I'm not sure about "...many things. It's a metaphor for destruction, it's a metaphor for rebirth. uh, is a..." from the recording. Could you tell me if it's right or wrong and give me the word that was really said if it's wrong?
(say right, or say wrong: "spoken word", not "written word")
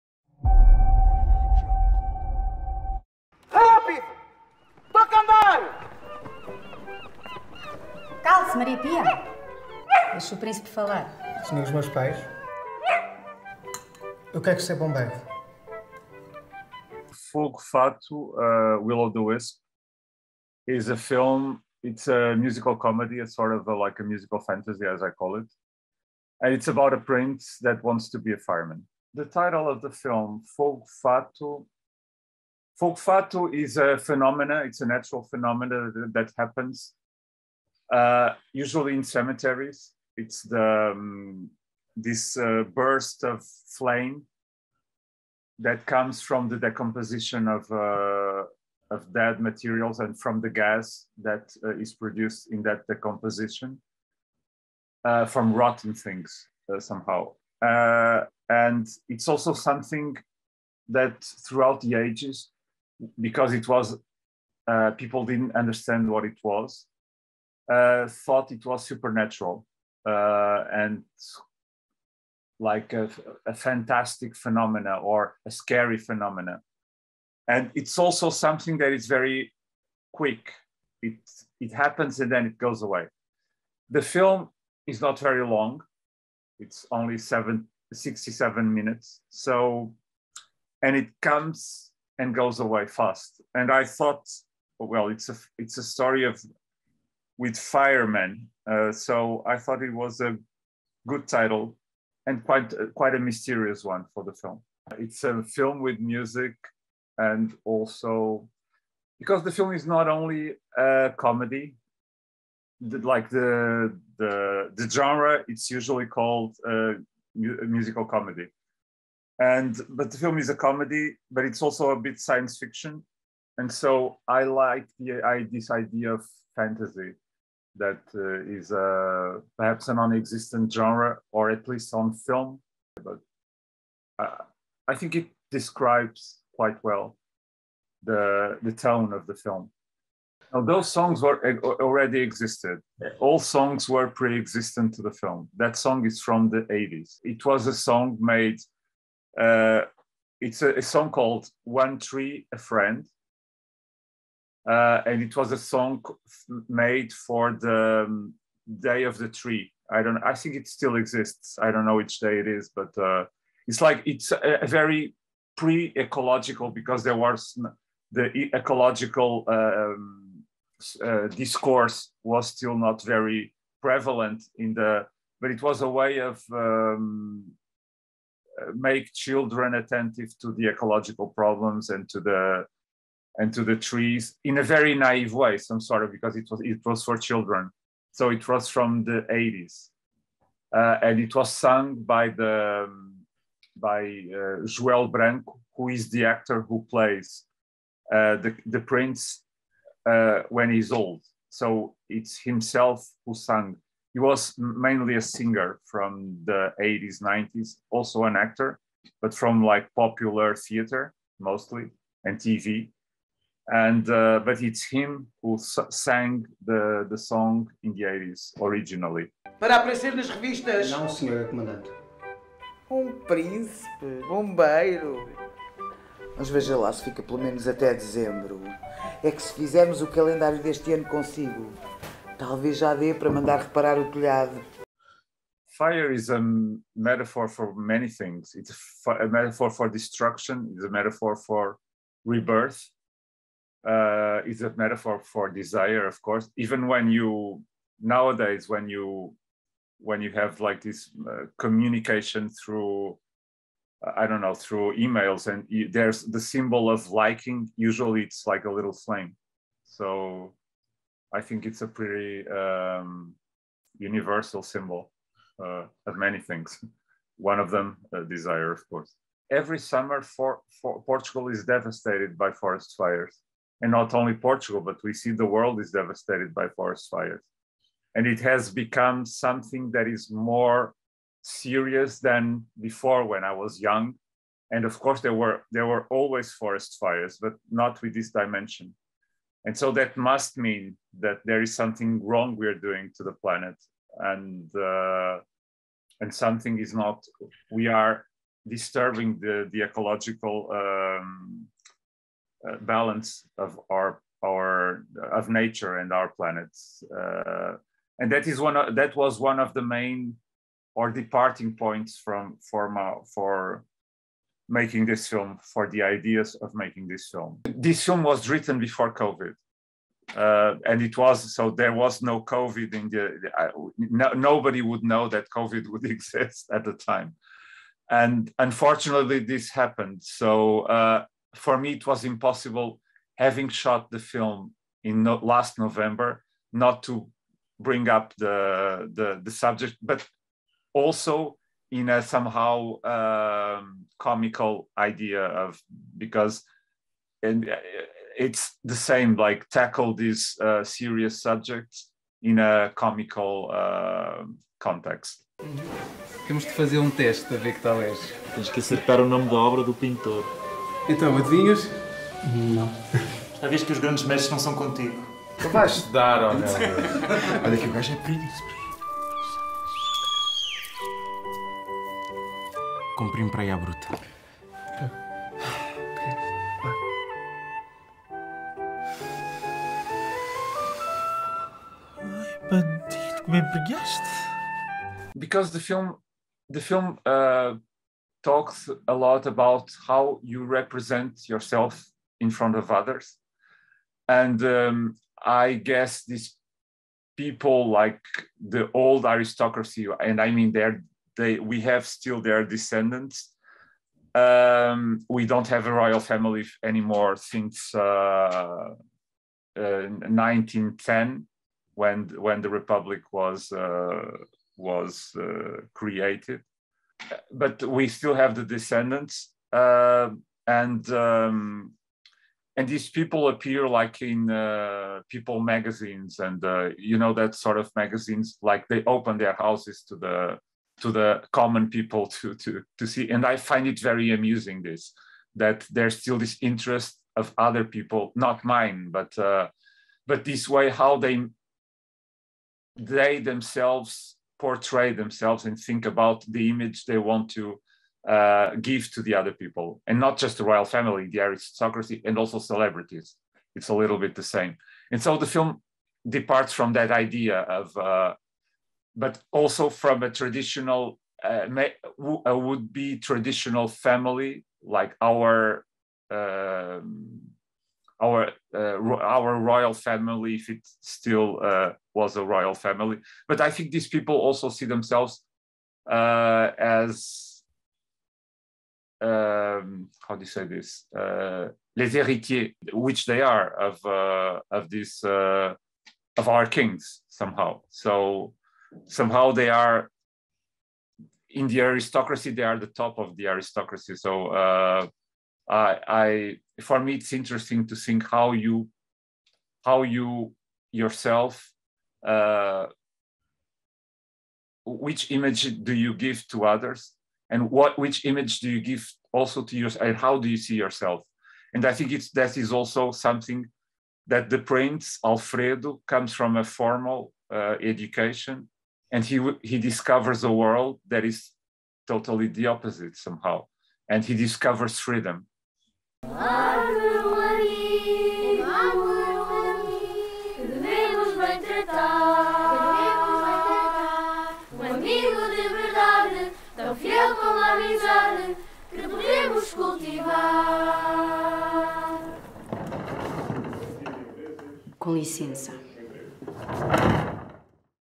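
right.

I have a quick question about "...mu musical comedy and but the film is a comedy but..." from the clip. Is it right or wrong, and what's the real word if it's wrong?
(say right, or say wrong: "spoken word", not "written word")
right.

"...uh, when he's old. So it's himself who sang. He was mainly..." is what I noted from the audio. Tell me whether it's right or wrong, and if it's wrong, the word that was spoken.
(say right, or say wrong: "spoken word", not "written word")
right.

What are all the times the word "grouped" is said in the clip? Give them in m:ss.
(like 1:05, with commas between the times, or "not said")
not said.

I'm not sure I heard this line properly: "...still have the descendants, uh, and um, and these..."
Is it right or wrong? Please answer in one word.
right.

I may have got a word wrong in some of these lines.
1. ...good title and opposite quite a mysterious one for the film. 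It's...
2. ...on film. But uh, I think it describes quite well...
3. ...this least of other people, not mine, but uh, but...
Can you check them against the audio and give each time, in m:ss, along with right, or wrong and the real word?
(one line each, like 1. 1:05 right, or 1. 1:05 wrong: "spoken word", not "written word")
1. 1:41 wrong: "quite", not "opposite"
2. 2:11 right
3. 7:16 wrong: "interest", not "least".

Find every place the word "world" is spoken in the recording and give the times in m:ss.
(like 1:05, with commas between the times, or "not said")
4:35, 8:40.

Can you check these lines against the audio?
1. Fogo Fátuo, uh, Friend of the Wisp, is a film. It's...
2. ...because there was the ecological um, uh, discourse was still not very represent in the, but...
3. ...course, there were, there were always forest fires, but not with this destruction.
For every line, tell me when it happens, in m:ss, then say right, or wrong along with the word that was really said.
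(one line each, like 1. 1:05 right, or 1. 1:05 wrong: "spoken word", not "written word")
1. 0:17 wrong: "Will", not "Friend"
2. 2:46 wrong: "prevalent", not "represent"
3. 4:44 wrong: "dimension", not "destruction".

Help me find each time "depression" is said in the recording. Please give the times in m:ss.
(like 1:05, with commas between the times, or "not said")
not said.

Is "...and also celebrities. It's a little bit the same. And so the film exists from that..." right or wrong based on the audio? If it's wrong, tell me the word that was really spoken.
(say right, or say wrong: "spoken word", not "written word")
wrong: "departs", not "exists".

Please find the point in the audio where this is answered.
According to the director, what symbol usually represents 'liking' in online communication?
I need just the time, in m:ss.
4:18.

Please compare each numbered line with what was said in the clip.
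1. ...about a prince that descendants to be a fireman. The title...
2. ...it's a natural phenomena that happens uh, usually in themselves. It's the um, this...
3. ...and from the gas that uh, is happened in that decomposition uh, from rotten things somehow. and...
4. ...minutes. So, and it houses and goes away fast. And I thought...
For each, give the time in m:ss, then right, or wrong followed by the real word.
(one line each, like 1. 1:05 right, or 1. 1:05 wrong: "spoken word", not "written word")
1. 0:26 wrong: "wants", not "descendants"
2. 0:34 wrong: "cemeteries", not "themselves"
3. 0:49 wrong: "produced", not "happened"
4. 1:28 wrong: "comes", not "houses".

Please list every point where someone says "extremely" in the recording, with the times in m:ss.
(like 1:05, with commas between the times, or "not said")
not said.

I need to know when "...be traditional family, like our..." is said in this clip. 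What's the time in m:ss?
7:42.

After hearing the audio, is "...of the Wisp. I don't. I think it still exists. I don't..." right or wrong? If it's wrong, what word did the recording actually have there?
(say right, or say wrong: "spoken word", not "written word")
wrong: "Tree", not "Wisp".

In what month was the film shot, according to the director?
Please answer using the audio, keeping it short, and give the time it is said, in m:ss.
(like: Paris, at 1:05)
November, at 5:35.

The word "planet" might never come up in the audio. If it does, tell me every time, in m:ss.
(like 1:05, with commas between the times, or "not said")
4:53, 5:06.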